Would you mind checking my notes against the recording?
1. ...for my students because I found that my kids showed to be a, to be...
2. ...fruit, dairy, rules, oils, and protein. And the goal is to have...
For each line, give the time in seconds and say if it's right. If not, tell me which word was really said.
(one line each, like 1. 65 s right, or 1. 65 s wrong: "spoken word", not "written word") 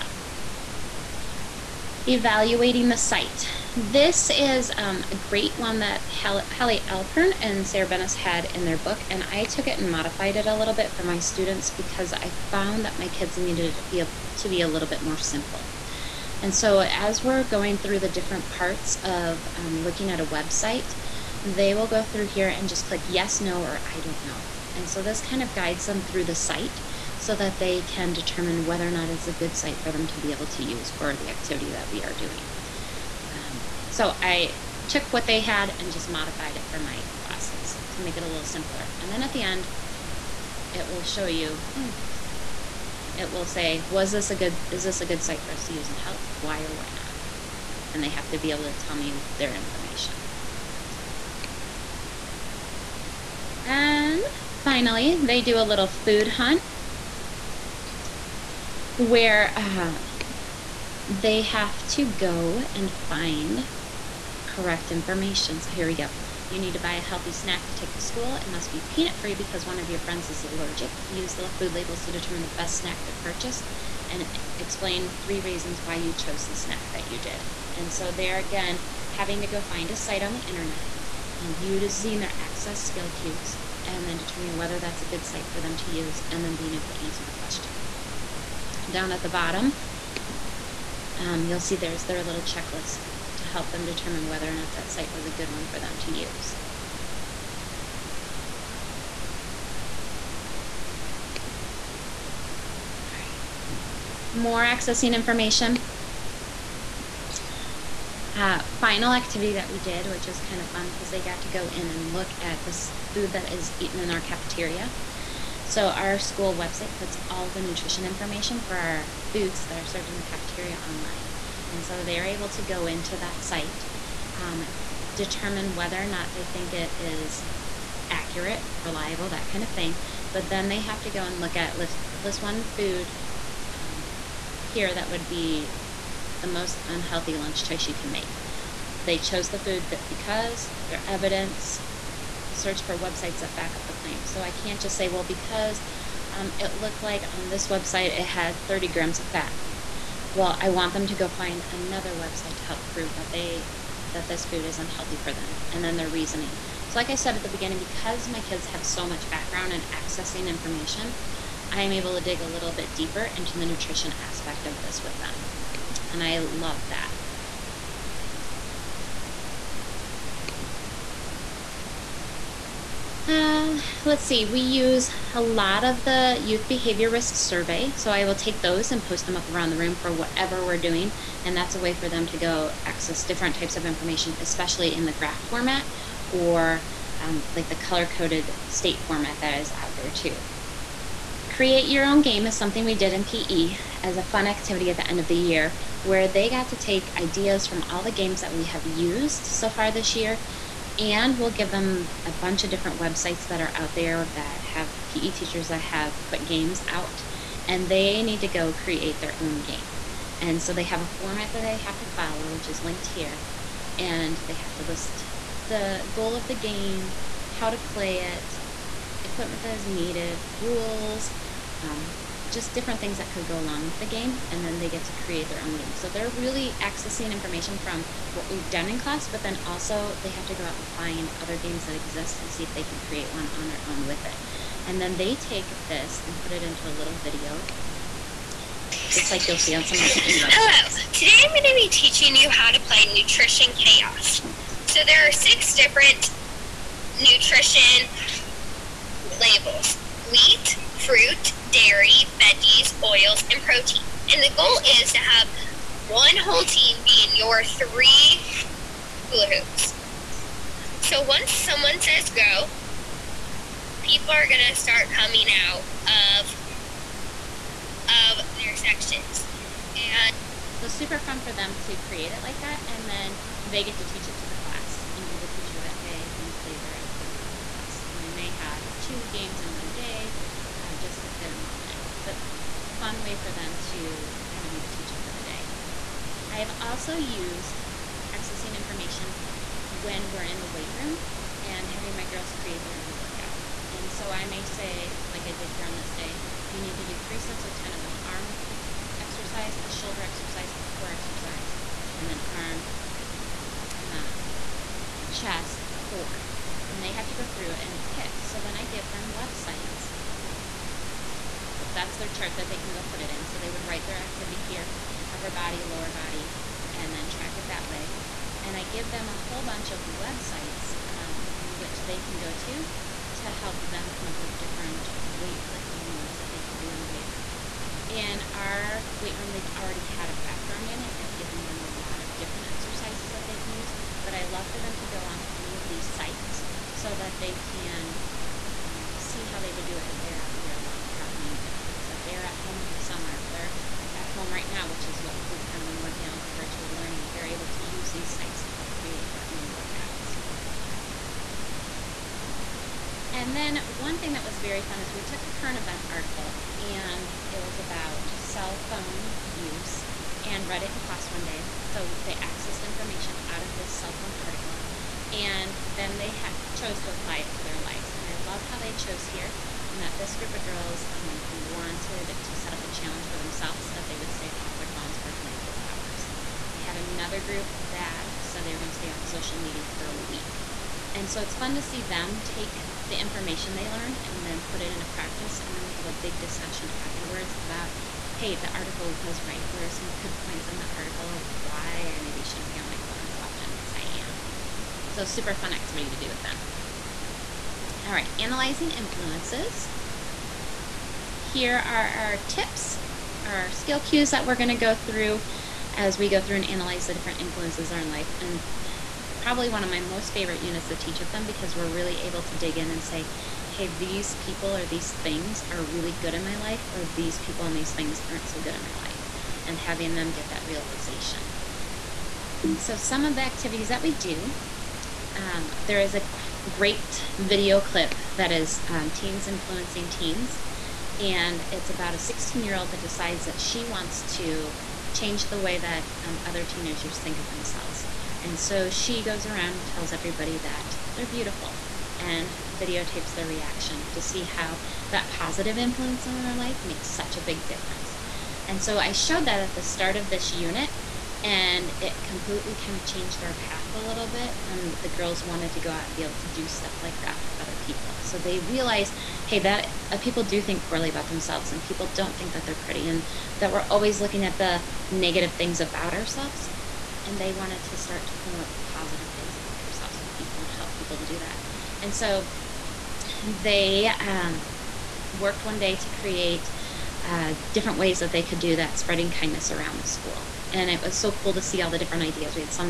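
1. 10 s wrong: "needed", not "showed"
2. 251 s wrong: "veggies", not "rules".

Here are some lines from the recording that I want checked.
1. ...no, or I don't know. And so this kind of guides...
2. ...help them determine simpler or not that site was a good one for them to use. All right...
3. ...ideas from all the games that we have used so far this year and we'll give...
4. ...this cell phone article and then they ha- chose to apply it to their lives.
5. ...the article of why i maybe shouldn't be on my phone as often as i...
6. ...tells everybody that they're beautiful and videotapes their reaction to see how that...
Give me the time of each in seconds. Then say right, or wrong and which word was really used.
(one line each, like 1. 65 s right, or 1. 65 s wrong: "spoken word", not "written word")
1. 23 s right
2. 93 s wrong: "whether", not "simpler"
3. 197 s right
4. 363 s right
5. 390 s right
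6. 439 s right.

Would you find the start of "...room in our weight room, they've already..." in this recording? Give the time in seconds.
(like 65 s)
327 s.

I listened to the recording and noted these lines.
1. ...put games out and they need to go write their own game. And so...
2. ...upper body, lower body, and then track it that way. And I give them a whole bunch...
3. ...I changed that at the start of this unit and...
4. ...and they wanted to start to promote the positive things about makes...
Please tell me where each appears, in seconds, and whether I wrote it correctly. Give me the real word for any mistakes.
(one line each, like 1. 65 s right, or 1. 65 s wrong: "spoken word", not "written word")
1. 206 s wrong: "create", not "write"
2. 315 s right
3. 448 s wrong: "showed", not "changed"
4. 467 s wrong: "ourselves", not "makes".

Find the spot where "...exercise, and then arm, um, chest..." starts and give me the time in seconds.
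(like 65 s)
301 s.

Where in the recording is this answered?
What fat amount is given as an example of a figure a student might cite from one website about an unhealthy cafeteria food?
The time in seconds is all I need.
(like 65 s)
148 s.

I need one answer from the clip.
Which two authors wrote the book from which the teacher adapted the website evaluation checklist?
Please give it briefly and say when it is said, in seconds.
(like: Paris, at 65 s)
Holly Alperin and Sarah Benes, at 6 s.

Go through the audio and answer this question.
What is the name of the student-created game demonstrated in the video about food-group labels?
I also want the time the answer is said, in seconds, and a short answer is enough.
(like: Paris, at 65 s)
Nutrition Chaos, at 243 s.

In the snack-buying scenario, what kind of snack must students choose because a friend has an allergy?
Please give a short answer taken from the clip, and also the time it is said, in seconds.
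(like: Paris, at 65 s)
peanut free, at 68 s.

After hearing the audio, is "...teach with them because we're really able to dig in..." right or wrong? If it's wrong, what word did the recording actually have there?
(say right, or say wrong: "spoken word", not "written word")
right.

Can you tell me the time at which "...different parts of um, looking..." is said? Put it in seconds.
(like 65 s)
18 s.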